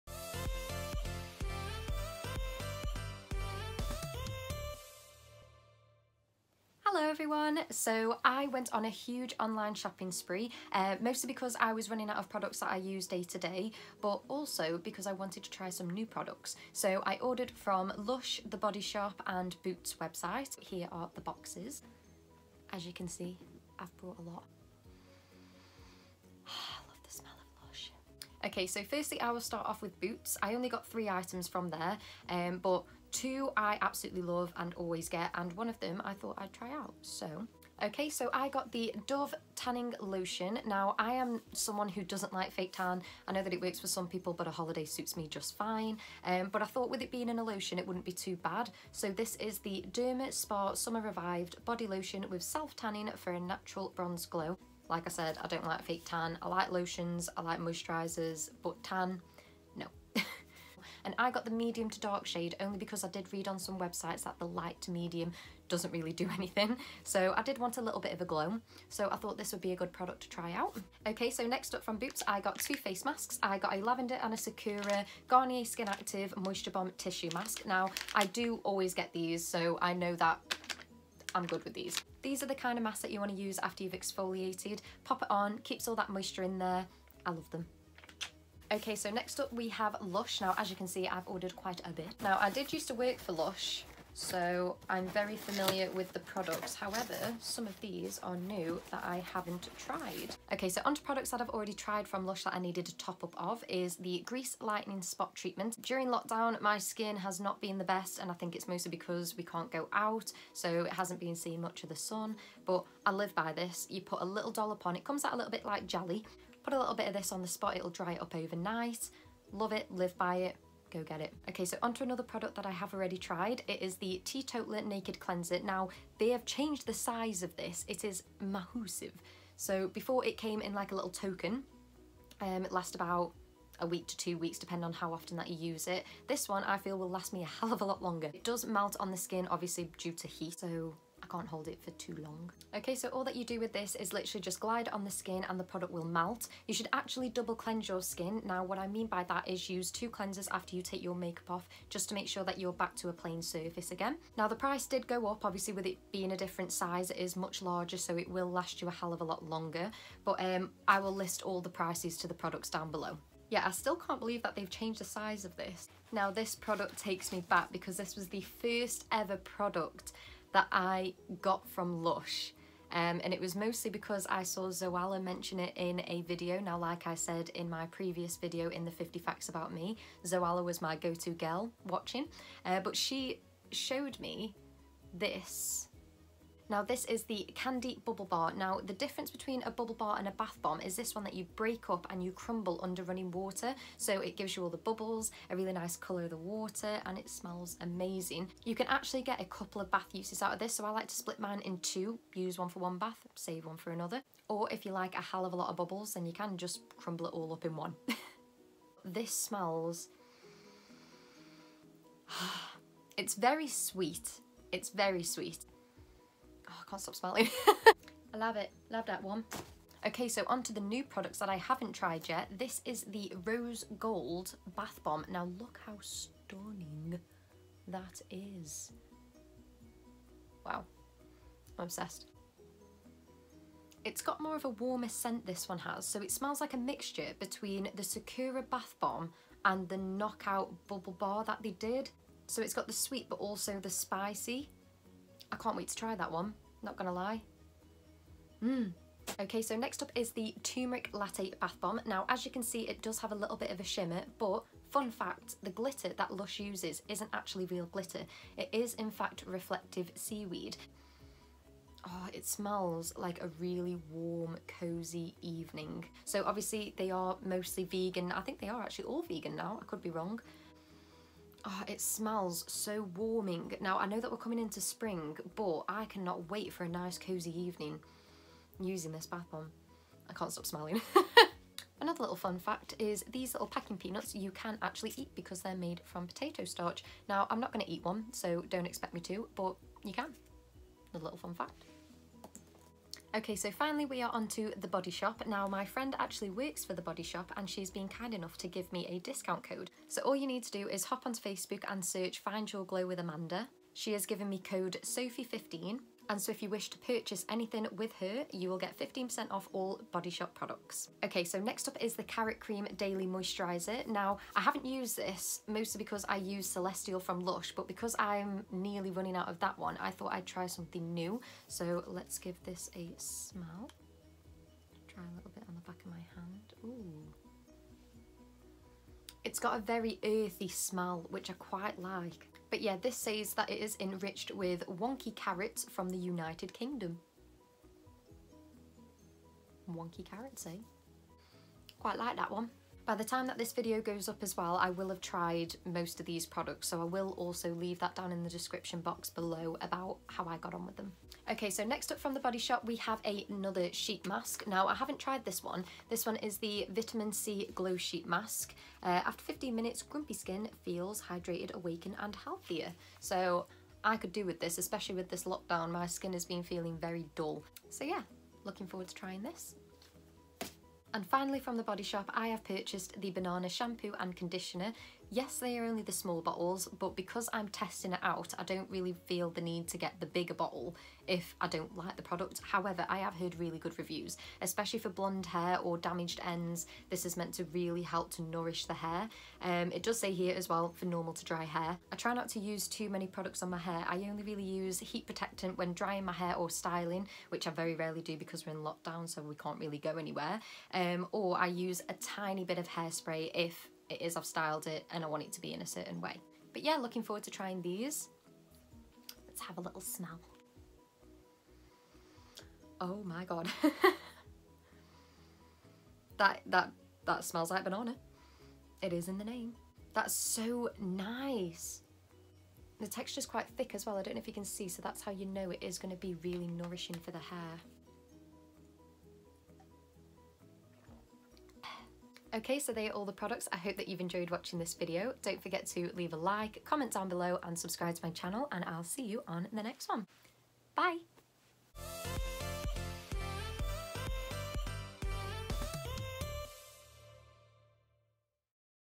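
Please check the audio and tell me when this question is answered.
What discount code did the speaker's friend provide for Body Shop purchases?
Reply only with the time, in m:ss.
5:05.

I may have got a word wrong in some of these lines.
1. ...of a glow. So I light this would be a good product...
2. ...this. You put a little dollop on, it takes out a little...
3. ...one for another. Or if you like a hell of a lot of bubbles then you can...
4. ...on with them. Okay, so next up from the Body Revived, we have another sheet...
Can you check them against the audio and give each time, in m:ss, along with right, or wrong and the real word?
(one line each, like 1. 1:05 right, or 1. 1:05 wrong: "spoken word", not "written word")
1. 1:08 wrong: "thought", not "light"
2. 1:53 wrong: "comes", not "takes"
3. 3:23 right
4. 5:50 wrong: "Shop", not "Revived".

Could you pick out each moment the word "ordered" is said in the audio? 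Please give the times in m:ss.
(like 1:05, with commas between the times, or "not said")
0:17, 1:31.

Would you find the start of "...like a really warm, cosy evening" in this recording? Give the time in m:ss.
4:23.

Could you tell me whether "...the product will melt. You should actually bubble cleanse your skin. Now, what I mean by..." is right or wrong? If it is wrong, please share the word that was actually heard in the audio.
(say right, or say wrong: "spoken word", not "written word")
wrong: "double", not "bubble".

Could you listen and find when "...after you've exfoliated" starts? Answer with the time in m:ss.
1:23.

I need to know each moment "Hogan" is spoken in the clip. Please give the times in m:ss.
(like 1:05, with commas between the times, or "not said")
not said.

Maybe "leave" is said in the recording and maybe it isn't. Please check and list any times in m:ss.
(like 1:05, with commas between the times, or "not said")
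5:47, 7:16.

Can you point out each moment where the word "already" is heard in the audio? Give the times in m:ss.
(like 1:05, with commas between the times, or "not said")
1:41, 2:02.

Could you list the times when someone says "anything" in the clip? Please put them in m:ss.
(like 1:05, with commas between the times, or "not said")
1:06, 5:07.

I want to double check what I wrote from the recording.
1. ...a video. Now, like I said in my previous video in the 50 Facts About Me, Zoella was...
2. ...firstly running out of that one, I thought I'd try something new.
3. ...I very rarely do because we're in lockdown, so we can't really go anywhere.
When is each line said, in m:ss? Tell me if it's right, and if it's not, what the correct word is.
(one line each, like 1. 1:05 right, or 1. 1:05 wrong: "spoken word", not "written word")
1. 2:56 right
2. 5:18 wrong: "nearly", not "firstly"
3. 6:37 right.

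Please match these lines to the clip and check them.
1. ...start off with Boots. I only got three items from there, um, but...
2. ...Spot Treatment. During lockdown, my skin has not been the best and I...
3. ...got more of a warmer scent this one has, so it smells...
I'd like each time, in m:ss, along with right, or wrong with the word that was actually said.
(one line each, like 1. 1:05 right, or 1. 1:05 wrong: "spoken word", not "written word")
1. 0:29 right
2. 1:45 right
3. 3:54 right.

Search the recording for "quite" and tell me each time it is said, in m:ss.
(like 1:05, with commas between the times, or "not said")
1:31, 5:31, 5:41, 7:03.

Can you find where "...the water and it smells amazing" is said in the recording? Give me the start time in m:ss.
3:16.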